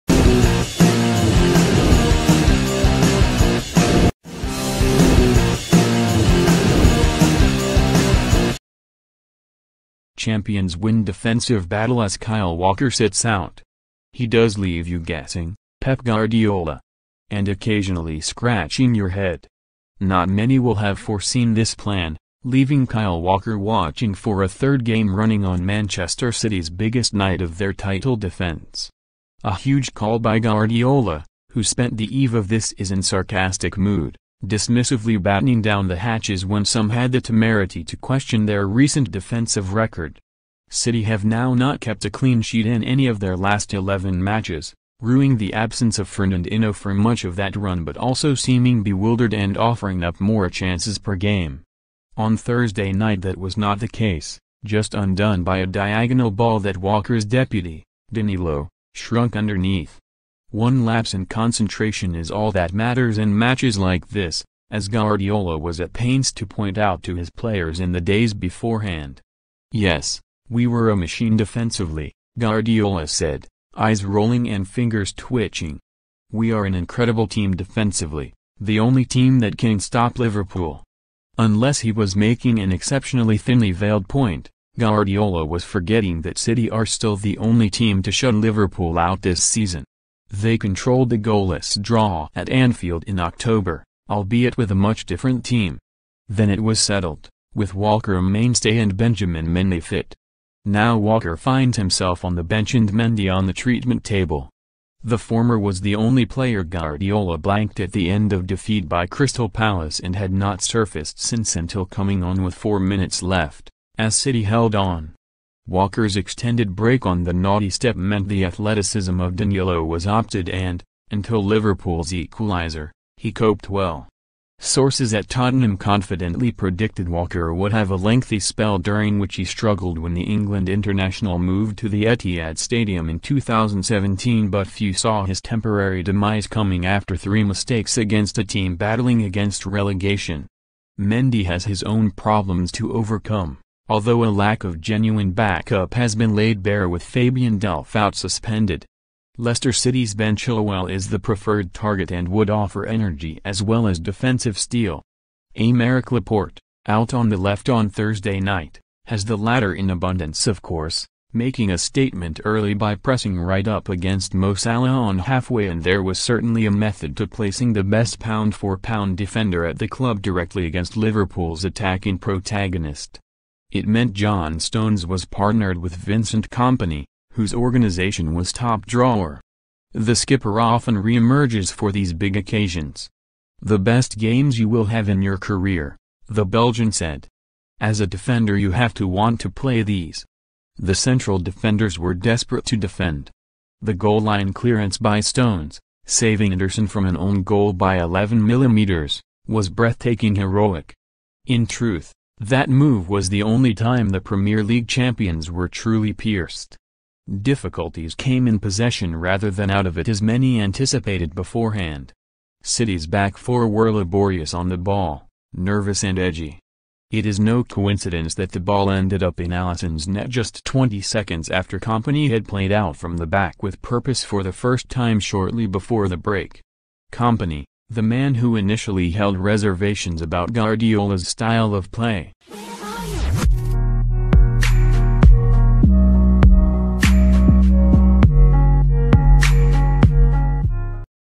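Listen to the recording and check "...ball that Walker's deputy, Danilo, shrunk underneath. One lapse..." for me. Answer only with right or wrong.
right.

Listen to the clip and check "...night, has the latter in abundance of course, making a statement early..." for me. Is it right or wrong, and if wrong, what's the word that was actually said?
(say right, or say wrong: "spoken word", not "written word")
right.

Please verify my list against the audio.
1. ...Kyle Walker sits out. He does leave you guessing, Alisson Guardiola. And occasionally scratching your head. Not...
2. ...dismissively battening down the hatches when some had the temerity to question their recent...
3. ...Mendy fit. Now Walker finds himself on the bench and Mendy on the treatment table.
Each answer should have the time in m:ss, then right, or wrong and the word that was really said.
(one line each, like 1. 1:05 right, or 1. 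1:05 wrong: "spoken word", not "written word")
1. 0:12 wrong: "Pep", not "Alisson"
2. 0:34 right
3. 1:39 right.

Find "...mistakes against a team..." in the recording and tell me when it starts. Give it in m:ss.
2:17.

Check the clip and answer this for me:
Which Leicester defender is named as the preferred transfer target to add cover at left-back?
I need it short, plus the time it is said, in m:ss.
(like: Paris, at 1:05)
Ben Chilwell, at 2:30.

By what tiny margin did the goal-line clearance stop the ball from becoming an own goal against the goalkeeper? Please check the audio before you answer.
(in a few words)
11 millimeters.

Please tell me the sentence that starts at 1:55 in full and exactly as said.
Walker's extended break on the naughty step meant the athleticism of Danilo was opted and, until Liverpool's equaliser, he coped well.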